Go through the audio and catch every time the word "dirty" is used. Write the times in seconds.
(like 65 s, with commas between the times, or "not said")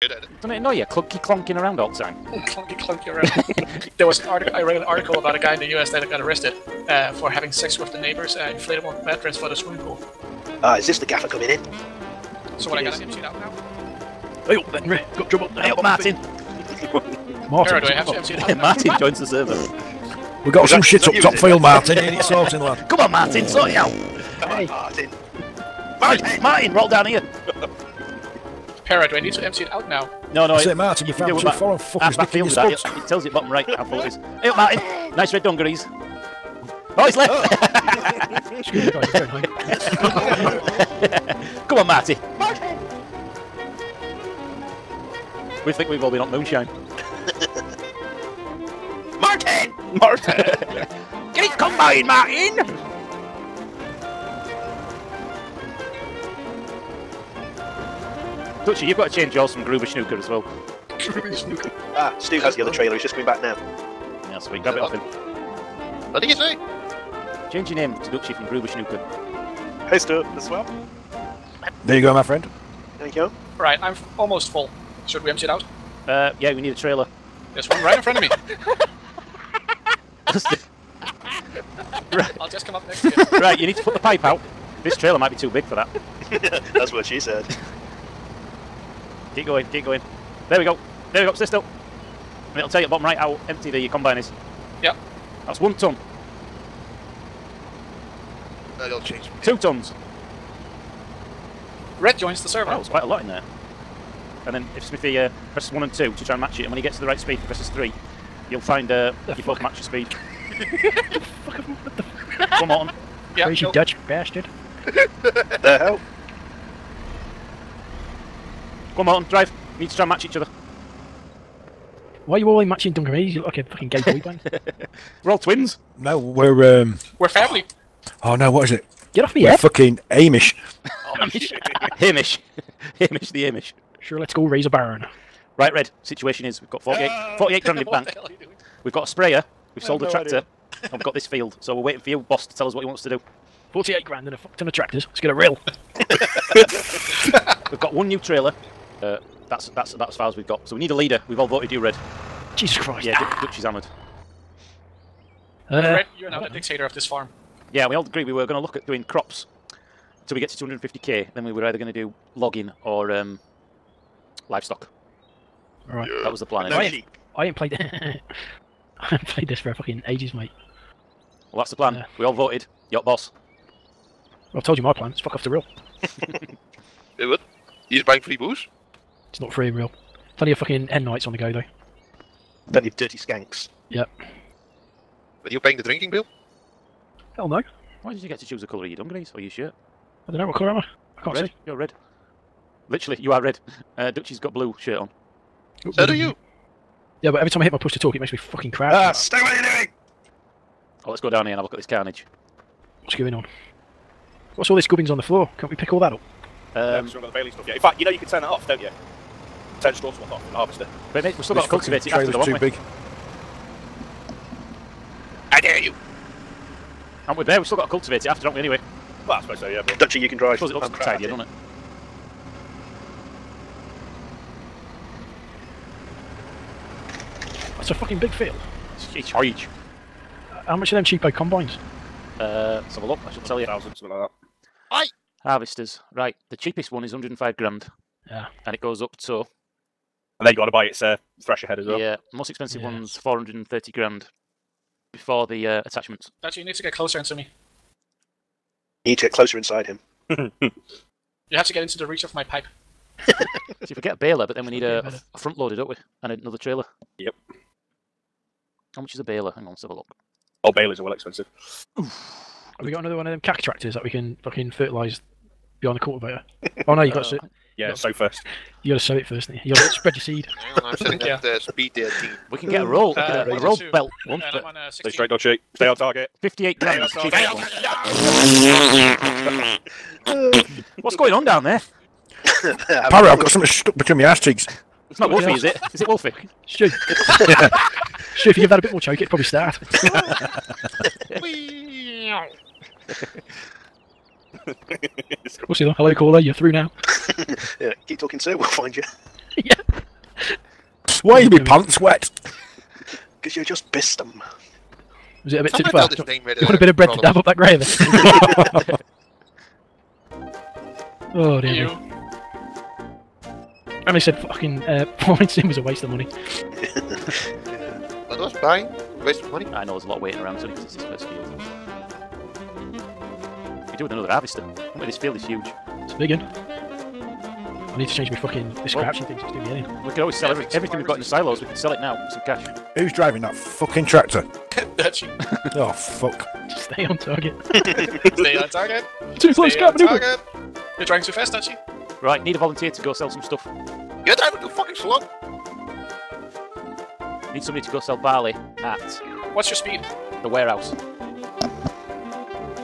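182 s.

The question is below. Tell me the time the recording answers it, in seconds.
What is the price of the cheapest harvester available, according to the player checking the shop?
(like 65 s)
237 s.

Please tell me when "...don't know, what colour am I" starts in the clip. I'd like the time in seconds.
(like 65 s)
190 s.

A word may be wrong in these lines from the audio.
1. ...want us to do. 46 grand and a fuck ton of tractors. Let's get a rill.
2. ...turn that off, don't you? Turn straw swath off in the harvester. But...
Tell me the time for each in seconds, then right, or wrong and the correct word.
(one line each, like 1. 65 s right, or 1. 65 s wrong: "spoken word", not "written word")
1. 142 s wrong: "48", not "46"
2. 208 s right.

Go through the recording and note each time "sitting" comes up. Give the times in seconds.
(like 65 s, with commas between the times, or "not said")
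270 s.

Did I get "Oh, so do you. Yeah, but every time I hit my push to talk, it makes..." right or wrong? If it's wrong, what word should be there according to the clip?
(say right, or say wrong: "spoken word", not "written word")
right.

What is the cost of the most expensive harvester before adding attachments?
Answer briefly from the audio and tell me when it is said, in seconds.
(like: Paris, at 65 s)
430 grand, at 243 s.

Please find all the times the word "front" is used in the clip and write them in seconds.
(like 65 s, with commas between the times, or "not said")
78 s, 255 s.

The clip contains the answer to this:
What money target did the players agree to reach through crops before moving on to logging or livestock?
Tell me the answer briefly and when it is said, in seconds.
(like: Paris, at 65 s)
250k, at 160 s.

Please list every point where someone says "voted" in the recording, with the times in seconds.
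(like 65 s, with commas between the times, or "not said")
151 s, 172 s.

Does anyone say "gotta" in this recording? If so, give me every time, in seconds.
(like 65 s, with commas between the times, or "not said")
267 s.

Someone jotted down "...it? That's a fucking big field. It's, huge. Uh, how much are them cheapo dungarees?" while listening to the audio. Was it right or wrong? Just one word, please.
wrong.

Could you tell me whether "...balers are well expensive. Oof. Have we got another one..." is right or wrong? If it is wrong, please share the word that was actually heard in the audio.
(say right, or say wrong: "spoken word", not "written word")
right.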